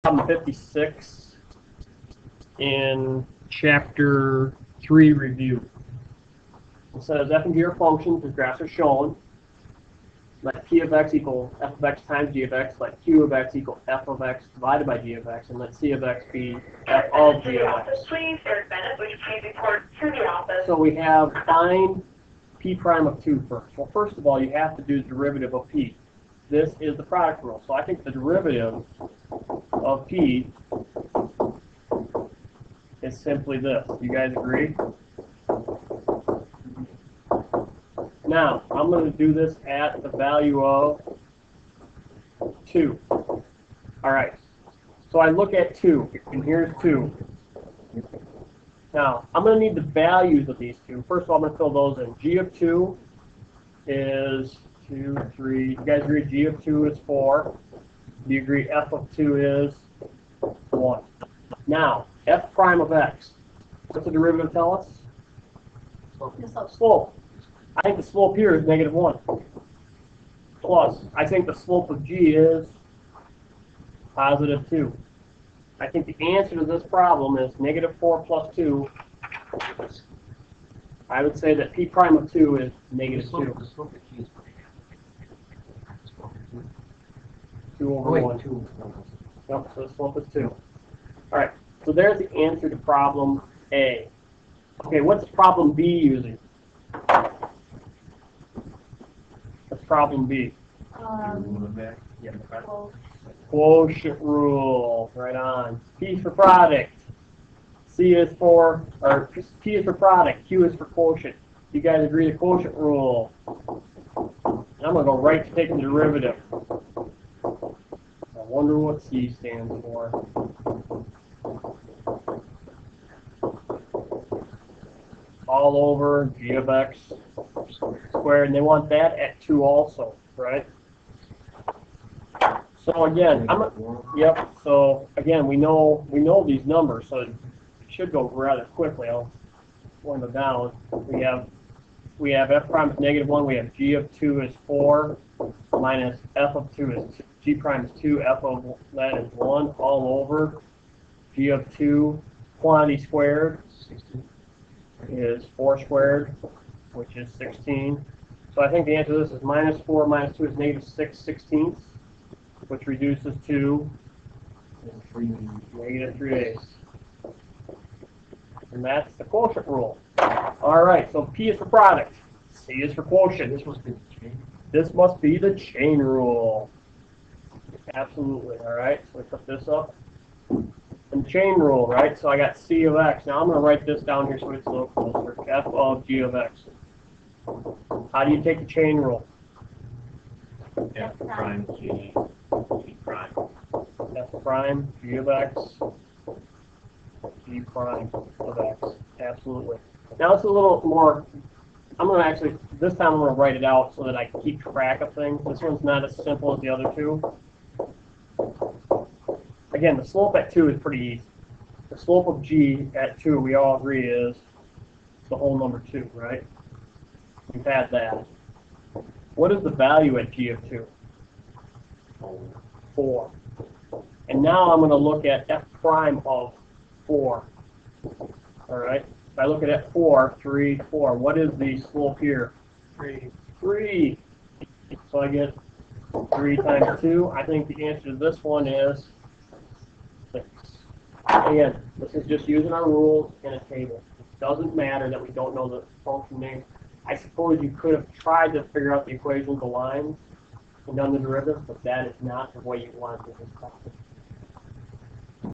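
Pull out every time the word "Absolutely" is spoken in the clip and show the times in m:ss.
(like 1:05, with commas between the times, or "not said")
2:57, 3:19.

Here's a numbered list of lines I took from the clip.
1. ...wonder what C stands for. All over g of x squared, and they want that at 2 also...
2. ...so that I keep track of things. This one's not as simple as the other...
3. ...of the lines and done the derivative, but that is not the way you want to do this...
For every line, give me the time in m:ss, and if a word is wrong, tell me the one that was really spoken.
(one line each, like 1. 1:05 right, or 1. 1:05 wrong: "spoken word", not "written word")
1. 1:58 right
2. 3:23 right
3. 4:09 right.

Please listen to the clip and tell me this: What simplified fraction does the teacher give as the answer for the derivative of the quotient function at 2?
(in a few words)
-3/8.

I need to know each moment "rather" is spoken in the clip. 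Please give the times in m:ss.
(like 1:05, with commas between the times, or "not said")
2:18.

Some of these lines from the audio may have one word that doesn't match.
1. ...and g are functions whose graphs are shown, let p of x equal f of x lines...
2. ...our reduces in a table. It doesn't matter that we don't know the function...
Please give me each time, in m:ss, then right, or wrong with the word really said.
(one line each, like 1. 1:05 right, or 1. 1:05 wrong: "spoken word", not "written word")
1. 0:07 wrong: "times", not "lines"
2. 4:02 wrong: "rules", not "reduces".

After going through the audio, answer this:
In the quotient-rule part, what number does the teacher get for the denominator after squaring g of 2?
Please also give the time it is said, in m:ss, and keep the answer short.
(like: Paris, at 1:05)
16, at 2:37.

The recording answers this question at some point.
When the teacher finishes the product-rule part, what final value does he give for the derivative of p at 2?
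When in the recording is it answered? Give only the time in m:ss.
1:22.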